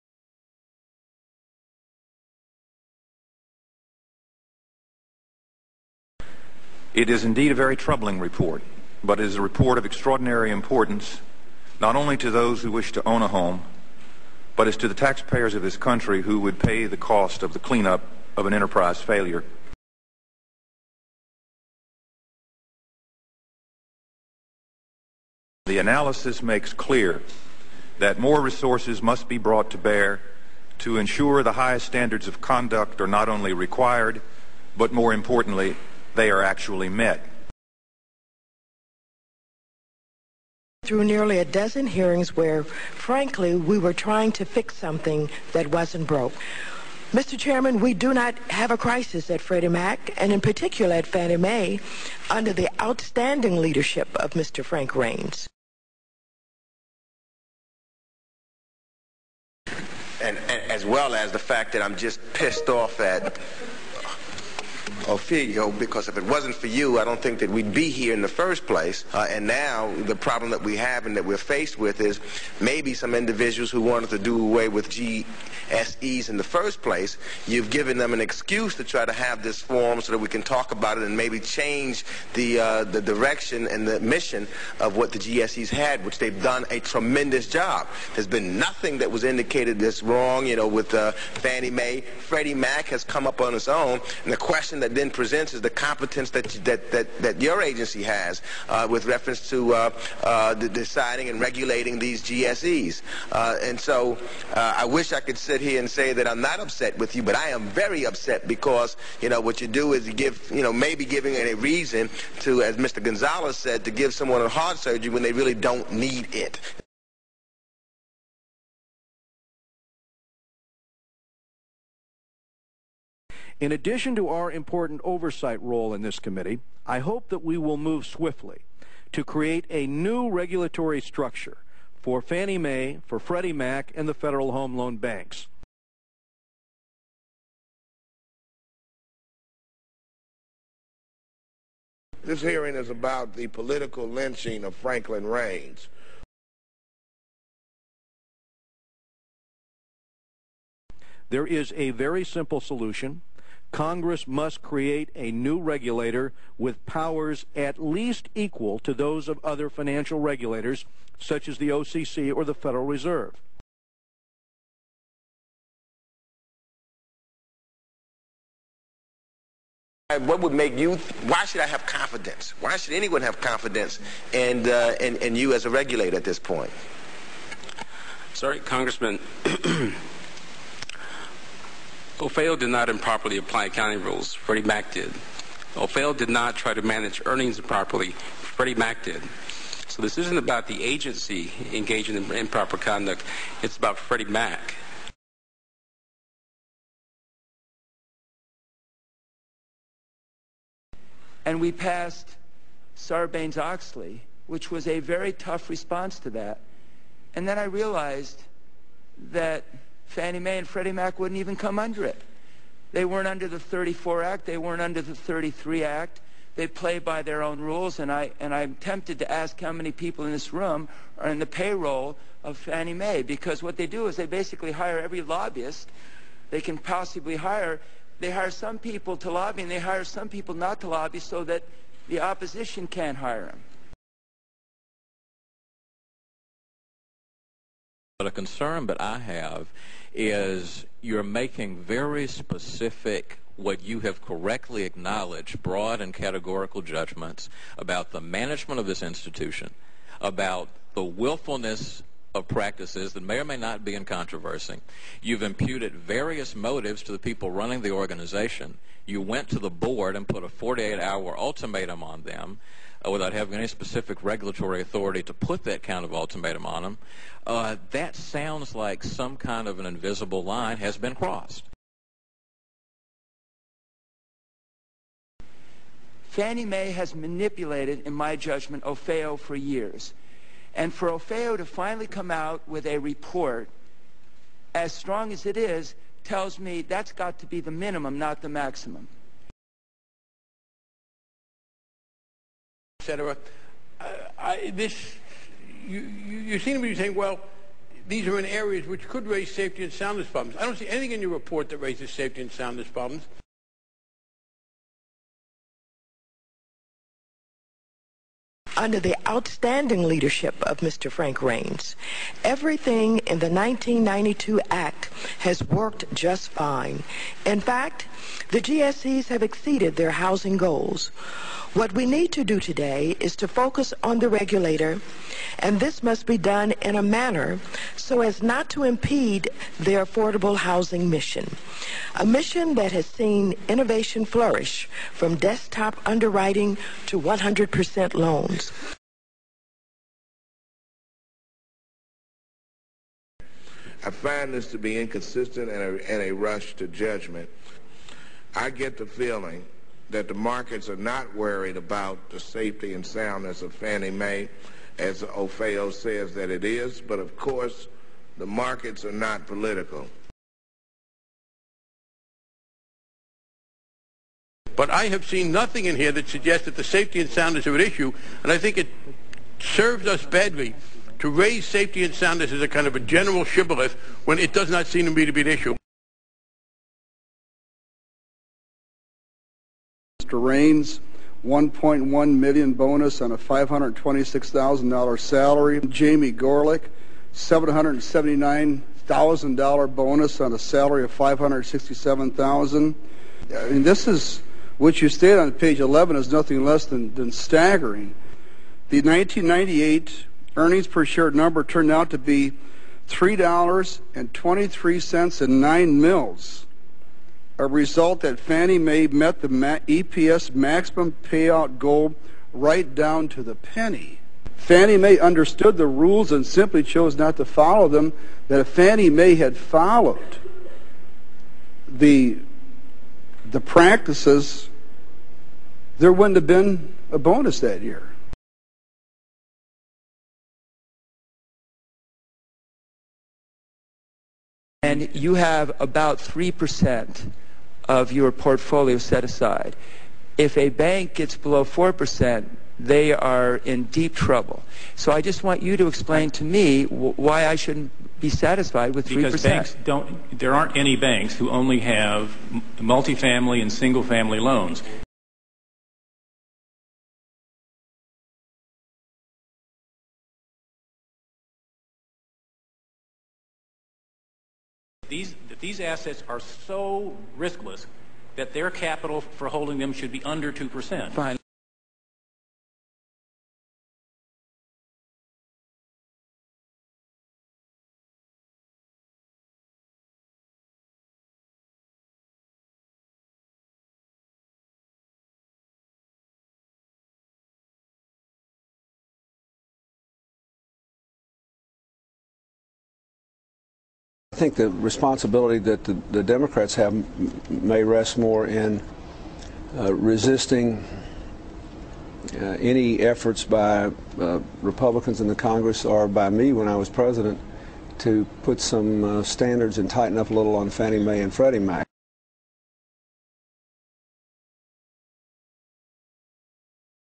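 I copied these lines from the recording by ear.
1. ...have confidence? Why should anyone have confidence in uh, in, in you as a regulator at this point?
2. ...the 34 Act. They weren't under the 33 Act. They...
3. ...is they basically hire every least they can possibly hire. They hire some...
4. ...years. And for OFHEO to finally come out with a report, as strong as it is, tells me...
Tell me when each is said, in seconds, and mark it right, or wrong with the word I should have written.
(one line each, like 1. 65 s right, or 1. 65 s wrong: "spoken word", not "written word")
1. 171 s right
2. 213 s right
3. 224 s wrong: "lobbyist", not "least"
4. 279 s right.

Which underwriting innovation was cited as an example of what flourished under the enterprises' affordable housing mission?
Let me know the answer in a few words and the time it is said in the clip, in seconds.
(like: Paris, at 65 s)
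desktop underwriting, at 335 s.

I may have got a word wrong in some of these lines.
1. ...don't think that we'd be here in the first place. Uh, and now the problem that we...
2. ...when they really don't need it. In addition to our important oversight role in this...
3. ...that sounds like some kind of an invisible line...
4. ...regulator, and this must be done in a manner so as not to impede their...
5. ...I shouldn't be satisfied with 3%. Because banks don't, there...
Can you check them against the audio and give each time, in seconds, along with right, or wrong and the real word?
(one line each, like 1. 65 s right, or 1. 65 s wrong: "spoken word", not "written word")
1. 67 s right
2. 115 s right
3. 267 s right
4. 324 s right
5. 447 s right.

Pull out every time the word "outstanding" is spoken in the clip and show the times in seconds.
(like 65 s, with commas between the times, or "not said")
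52 s, 309 s.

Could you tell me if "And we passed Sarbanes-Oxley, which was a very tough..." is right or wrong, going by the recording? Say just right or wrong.
right.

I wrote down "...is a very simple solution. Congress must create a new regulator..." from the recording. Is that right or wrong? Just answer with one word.
right.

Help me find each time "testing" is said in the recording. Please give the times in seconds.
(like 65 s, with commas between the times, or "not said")
not said.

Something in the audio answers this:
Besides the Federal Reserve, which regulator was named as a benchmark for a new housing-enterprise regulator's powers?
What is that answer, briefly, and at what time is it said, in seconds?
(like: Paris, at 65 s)
OCC, at 161 s.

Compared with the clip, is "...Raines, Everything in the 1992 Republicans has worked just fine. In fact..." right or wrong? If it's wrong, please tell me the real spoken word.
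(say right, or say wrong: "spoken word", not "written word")
wrong: "Act", not "Republicans".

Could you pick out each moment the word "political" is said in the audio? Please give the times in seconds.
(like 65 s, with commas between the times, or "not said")
143 s, 359 s.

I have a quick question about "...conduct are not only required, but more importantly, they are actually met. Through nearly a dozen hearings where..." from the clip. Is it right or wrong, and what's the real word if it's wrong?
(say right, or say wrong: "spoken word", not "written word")
right.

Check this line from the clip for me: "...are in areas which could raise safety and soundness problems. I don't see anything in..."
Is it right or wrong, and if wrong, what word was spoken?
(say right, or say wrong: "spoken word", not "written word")
right.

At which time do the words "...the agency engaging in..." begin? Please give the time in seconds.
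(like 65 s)
190 s.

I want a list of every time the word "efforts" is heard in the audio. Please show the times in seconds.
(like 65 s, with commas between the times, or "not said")
503 s.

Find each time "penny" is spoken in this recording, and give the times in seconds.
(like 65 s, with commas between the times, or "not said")
413 s.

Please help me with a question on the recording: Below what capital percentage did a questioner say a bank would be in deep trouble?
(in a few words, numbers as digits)
4%.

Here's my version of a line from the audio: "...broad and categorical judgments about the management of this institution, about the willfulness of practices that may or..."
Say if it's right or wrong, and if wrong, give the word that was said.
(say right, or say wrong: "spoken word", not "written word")
right.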